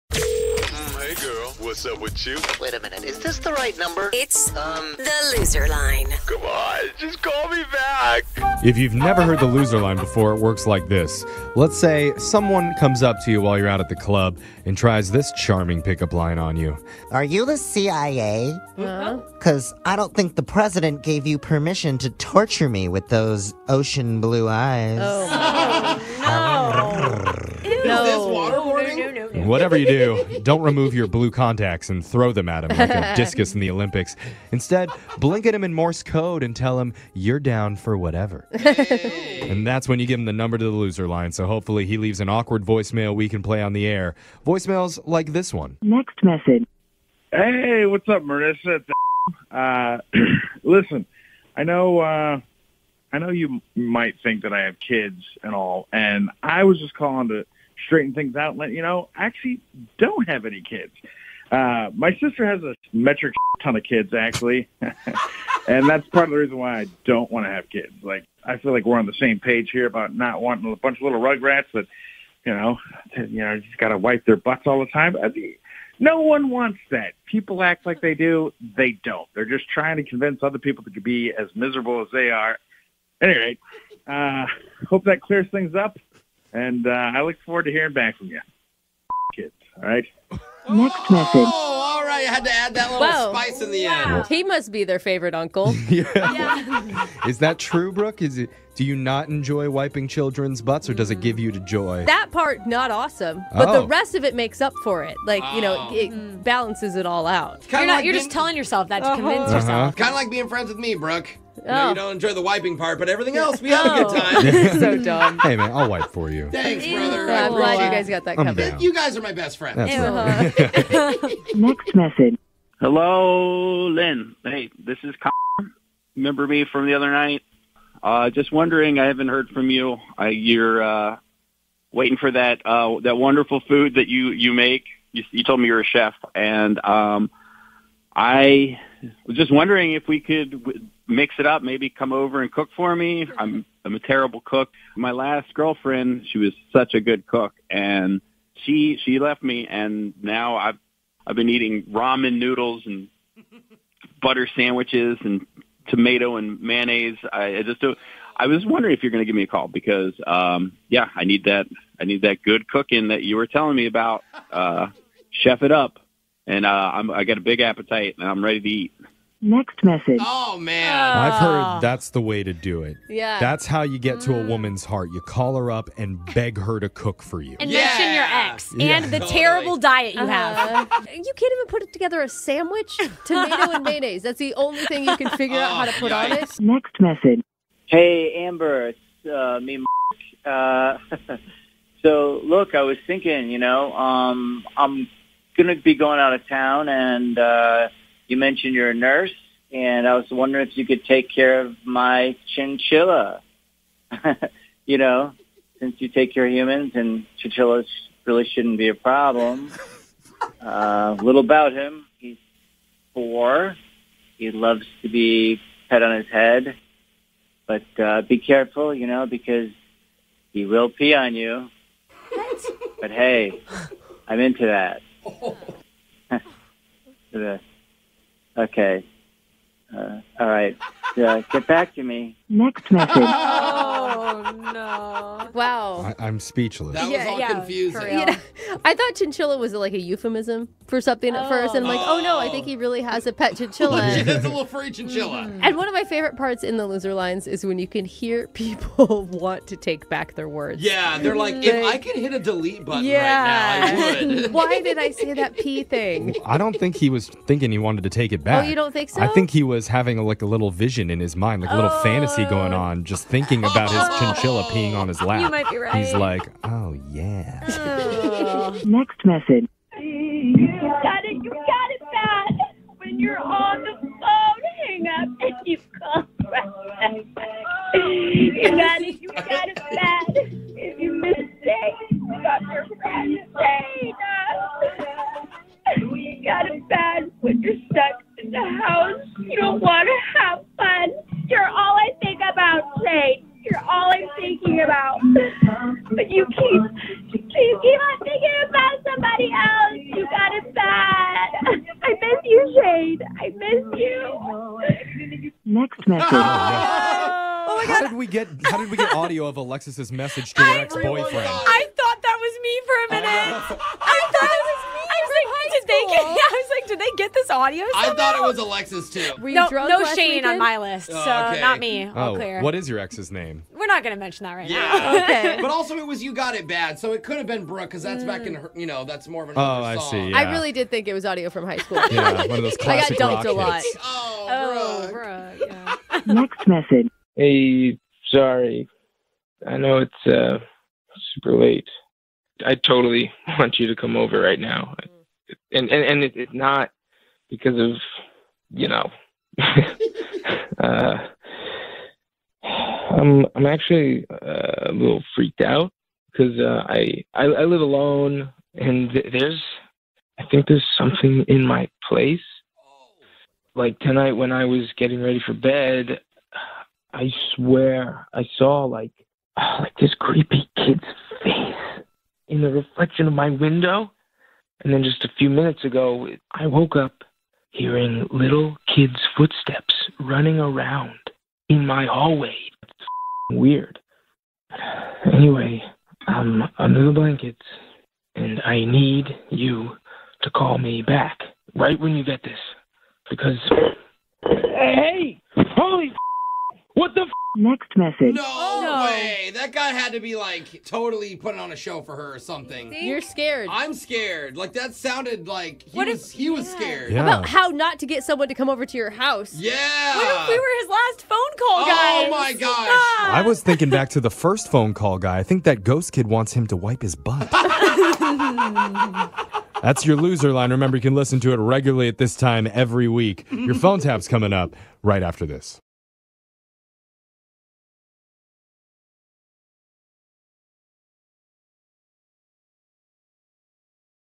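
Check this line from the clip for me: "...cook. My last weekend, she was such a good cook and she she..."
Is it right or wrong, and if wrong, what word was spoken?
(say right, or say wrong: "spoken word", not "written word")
wrong: "girlfriend", not "weekend".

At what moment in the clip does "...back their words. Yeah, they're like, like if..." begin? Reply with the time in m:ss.
4:10.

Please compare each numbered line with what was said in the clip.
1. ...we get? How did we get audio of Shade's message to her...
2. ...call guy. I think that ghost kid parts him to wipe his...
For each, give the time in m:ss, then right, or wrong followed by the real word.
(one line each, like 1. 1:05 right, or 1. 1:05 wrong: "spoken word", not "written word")
1. 5:08 wrong: "Alexis", not "Shade"
2. 6:54 wrong: "wants", not "parts".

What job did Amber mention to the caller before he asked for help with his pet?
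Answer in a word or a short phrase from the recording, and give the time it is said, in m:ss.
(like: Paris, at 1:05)
Nurse, at 3:18.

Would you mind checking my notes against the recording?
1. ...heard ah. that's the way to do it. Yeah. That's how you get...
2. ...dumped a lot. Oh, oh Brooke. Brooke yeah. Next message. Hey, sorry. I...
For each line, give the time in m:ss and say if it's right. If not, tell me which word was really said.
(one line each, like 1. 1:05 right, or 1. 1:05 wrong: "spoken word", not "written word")
1. 2:51 right
2. 5:33 right.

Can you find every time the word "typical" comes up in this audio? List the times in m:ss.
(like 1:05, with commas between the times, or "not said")
not said.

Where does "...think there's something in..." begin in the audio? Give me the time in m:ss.
6:00.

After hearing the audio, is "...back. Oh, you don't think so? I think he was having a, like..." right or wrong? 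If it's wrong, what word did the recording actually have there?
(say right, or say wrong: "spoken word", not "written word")
right.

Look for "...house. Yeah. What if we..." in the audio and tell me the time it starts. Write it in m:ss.
6:49.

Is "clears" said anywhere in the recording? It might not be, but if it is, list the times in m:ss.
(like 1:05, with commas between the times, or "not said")
1:25, 5:22.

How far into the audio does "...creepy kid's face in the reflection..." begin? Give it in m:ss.
6:10.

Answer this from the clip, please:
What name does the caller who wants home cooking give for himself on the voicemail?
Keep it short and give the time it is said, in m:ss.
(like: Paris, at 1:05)
Connor, at 2:05.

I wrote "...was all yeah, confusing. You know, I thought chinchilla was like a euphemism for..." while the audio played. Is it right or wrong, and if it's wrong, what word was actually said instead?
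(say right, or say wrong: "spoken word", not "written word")
right.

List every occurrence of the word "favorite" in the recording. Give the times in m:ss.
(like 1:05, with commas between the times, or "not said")
1:34, 4:06.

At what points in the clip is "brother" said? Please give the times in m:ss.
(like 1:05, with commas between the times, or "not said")
1:56.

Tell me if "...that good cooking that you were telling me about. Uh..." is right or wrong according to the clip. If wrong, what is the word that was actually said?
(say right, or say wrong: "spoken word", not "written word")
right.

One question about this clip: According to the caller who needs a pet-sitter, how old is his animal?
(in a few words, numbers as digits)
4.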